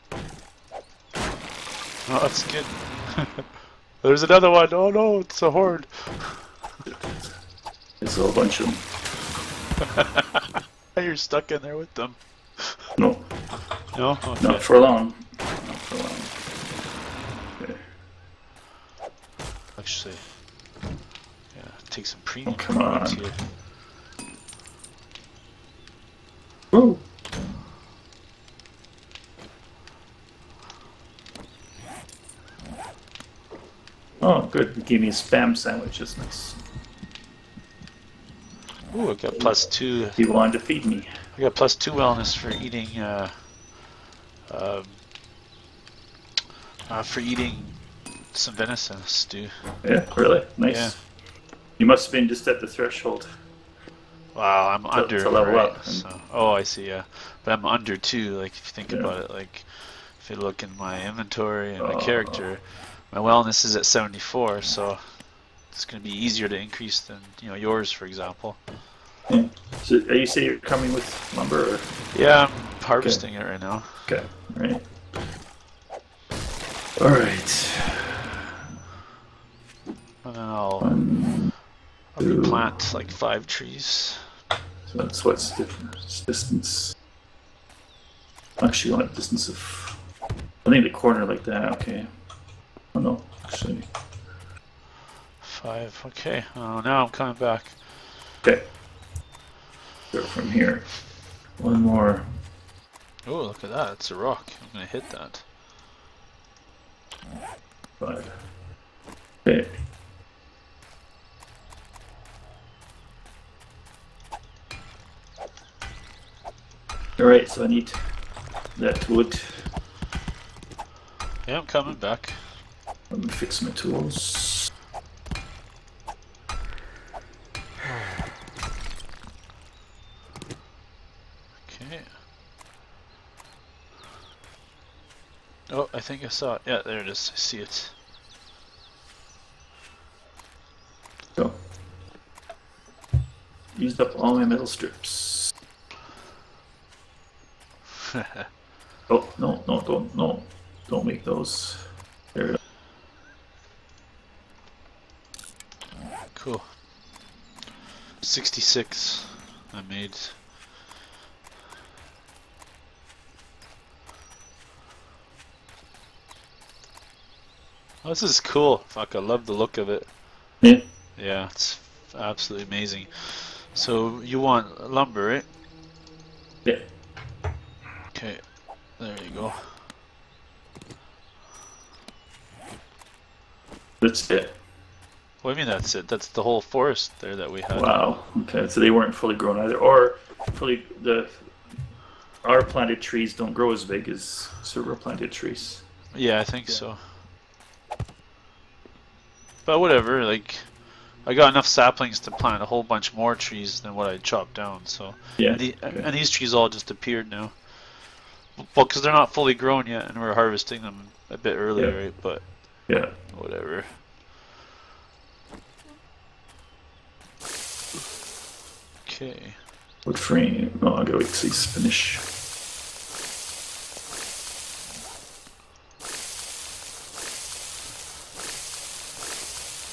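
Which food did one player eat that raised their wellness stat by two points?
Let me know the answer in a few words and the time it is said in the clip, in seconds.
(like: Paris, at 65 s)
venison stew, at 48 s.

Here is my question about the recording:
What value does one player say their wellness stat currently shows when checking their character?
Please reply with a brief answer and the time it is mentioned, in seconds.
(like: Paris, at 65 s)
74, at 63 s.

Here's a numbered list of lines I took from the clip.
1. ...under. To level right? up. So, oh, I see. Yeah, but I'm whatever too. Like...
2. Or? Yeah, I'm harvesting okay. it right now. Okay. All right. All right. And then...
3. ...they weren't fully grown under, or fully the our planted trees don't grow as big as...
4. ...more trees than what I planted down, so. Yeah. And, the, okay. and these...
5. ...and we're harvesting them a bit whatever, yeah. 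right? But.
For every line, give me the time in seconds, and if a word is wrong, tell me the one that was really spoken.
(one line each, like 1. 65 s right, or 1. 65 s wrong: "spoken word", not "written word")
1. 54 s wrong: "under", not "whatever"
2. 71 s right
3. 188 s wrong: "either", not "under"
4. 203 s wrong: "chopped", not "planted"
5. 210 s wrong: "earlier", not "whatever".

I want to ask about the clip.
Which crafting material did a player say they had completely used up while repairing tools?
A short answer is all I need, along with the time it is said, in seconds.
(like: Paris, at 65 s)
metal strips, at 144 s.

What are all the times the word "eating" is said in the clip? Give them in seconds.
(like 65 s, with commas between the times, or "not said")
42 s, 47 s.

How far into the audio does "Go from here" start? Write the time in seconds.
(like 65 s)
100 s.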